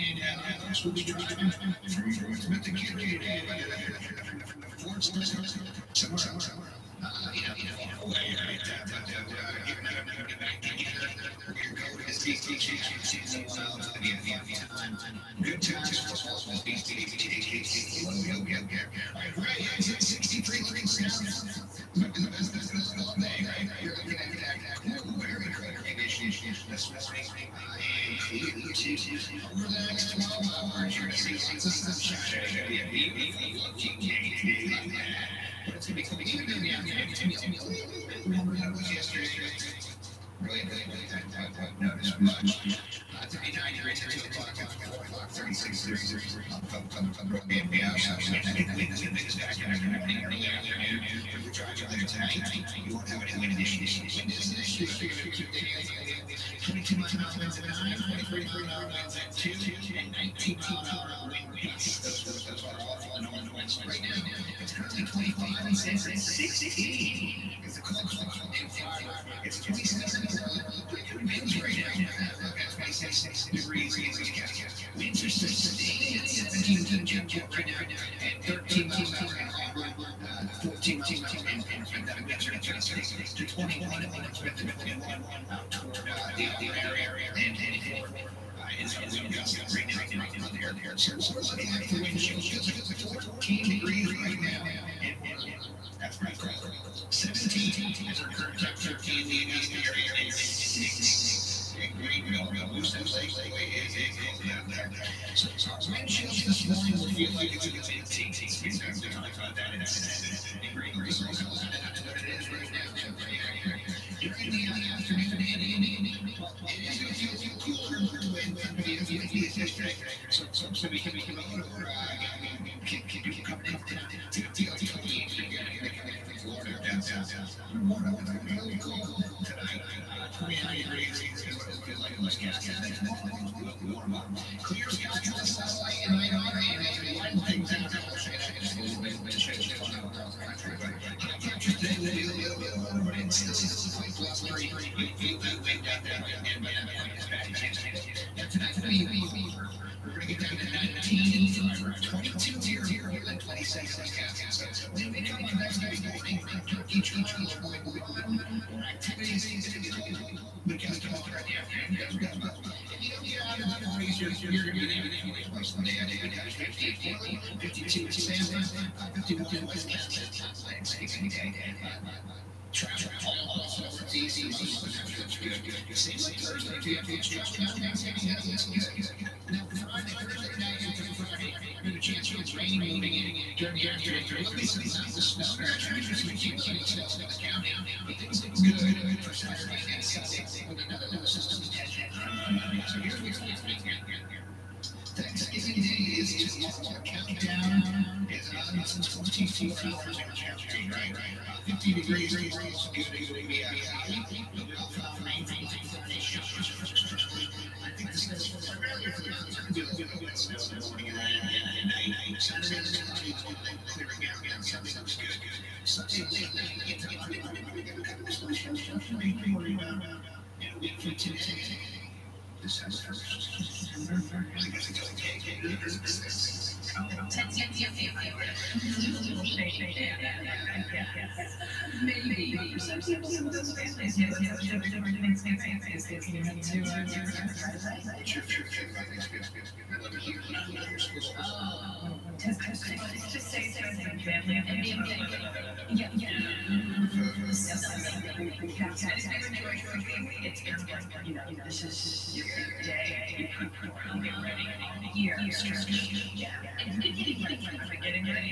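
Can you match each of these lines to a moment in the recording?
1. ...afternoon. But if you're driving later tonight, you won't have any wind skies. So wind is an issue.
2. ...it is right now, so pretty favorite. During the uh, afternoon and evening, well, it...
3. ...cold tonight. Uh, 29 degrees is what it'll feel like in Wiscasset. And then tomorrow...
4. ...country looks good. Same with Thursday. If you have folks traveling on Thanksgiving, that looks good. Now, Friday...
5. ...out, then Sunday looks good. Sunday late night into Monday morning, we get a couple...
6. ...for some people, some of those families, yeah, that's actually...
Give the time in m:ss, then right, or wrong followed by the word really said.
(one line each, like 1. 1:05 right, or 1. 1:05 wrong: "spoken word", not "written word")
1. 0:50 wrong: "issues", not "skies"
2. 1:52 wrong: "accurate", not "favorite"
3. 2:08 right
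4. 2:54 right
5. 3:34 right
6. 3:52 right.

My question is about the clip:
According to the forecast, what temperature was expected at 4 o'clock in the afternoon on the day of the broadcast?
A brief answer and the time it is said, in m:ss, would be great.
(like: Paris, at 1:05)
36 degrees, at 0:45.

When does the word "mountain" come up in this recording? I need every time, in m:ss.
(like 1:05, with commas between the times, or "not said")
3:04, 3:29.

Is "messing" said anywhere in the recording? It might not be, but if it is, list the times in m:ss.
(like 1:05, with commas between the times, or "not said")
not said.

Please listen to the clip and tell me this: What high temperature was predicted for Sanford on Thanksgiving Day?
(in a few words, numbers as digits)
52.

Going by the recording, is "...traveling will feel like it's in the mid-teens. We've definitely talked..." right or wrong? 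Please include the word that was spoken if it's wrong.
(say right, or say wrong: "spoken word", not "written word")
wrong: "morning", not "traveling".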